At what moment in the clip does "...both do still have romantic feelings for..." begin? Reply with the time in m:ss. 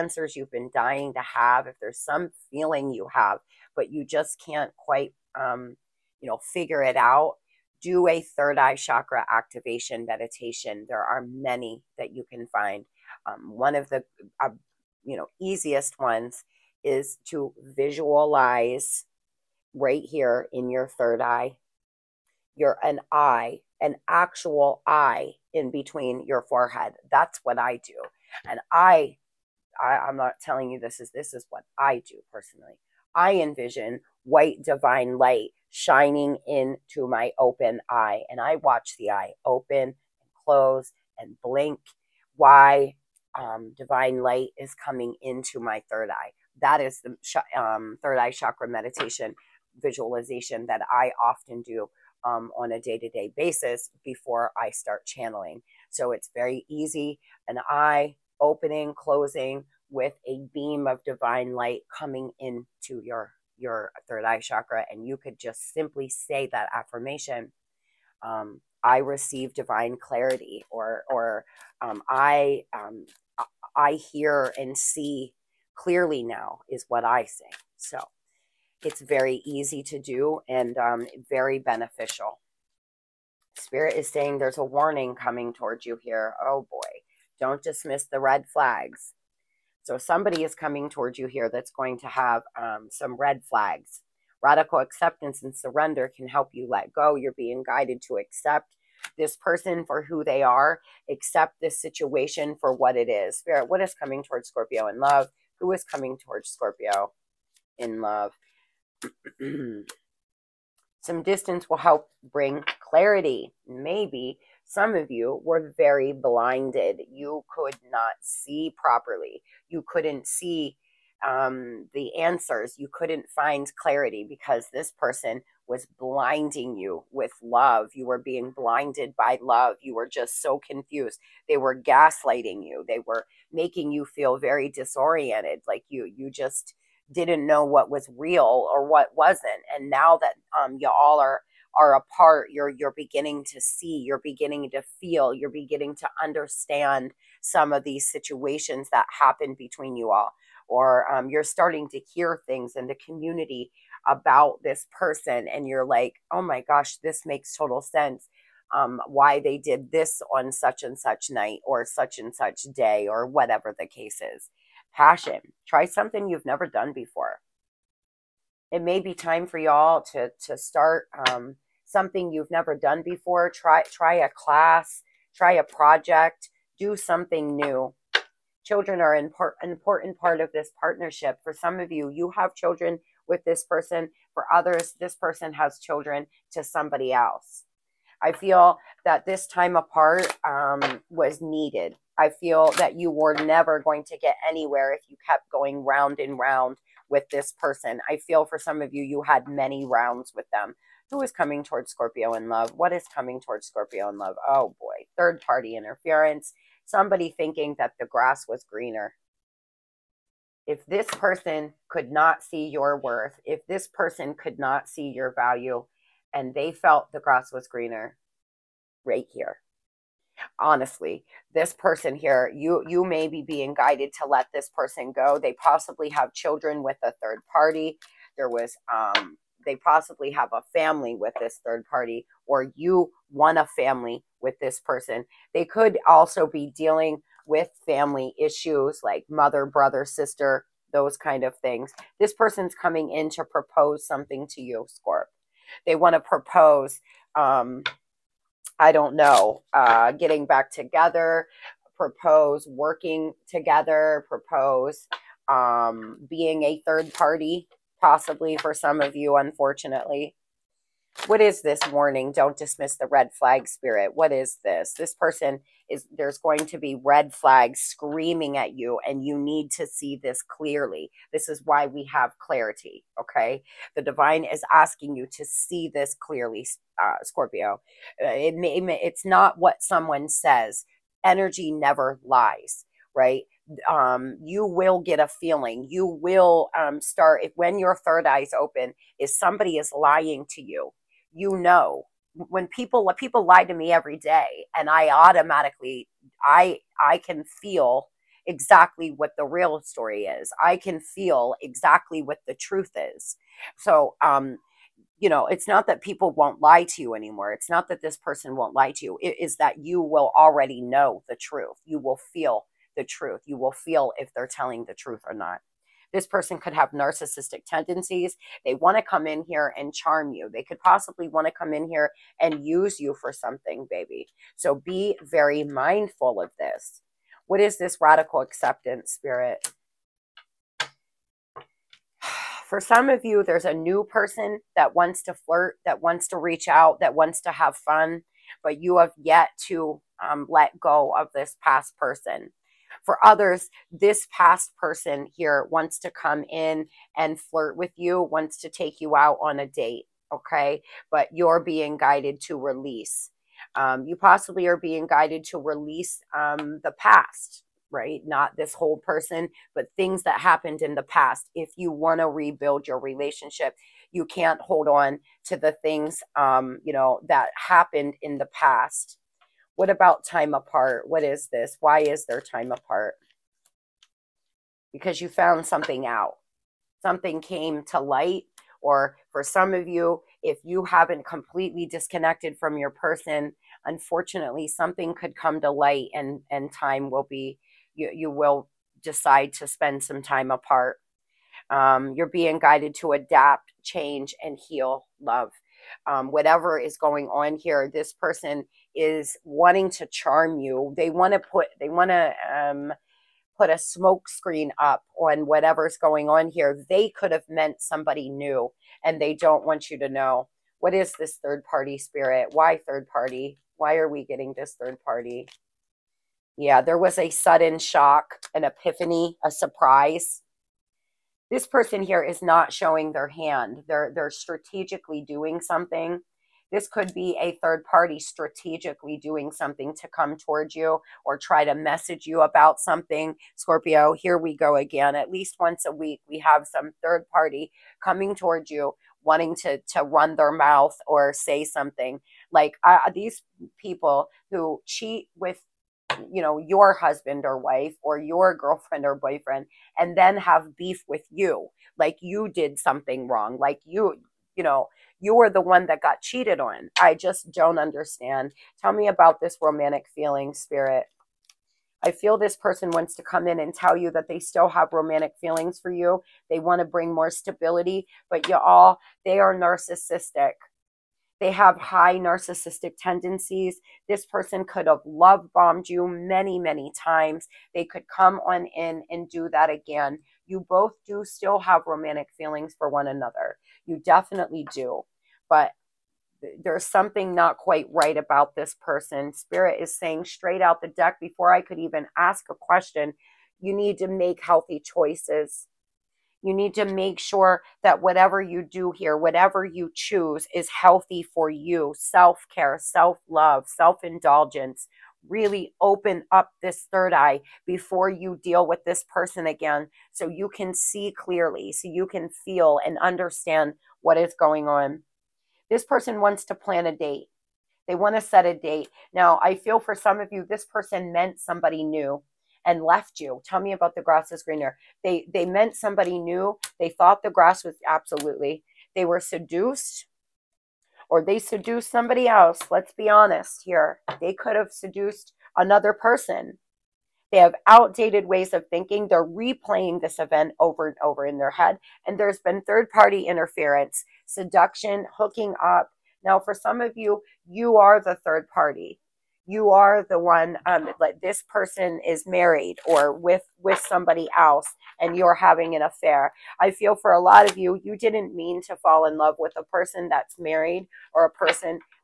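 8:00.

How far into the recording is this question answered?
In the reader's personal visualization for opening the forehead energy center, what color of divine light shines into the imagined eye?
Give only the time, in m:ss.
0:34.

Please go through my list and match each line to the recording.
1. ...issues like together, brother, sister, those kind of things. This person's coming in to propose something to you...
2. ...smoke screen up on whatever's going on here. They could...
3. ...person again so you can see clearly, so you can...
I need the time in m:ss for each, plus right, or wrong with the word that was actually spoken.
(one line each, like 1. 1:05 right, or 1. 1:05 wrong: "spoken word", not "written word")
1. 3:58 wrong: "mother", not "together"
2. 6:43 right
3. 8:29 right.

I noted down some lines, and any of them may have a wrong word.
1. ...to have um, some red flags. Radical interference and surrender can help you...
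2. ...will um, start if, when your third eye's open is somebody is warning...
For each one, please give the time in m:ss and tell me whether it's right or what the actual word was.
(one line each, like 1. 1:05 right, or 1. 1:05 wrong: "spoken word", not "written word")
1. 1:31 wrong: "acceptance", not "interference"
2. 4:46 wrong: "lying", not "warning".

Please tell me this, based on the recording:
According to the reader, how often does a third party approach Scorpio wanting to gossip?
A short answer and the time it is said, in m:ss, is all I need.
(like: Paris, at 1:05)
Once a week, at 7:15.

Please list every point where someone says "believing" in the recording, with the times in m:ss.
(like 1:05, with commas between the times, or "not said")
not said.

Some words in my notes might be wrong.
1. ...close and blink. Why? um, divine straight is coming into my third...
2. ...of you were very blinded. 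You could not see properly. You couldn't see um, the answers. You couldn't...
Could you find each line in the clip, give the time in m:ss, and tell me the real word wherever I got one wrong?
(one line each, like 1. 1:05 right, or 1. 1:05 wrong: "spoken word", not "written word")
1. 0:40 wrong: "light", not "straight"
2. 1:54 right.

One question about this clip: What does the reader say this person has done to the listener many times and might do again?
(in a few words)
Love bombed.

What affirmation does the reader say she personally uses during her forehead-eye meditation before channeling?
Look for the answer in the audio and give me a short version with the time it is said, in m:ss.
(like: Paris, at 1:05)
I hear and see clearly now, at 1:13.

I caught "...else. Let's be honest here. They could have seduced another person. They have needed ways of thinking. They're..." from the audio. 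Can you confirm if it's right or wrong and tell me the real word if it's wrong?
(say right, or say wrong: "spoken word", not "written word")
wrong: "outdated", not "needed".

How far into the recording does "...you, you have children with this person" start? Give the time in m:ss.
3:01.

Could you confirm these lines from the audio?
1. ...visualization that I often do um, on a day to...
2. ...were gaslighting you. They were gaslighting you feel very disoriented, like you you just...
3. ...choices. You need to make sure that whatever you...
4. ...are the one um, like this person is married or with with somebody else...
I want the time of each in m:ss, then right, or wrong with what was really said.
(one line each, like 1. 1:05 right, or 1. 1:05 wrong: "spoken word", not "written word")
1. 0:49 right
2. 2:11 wrong: "making", not "gaslighting"
3. 8:14 right
4. 9:09 right.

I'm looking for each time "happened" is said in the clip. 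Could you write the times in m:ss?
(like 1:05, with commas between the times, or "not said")
2:29, 6:00, 6:07.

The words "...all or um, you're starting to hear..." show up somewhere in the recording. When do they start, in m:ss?
2:30.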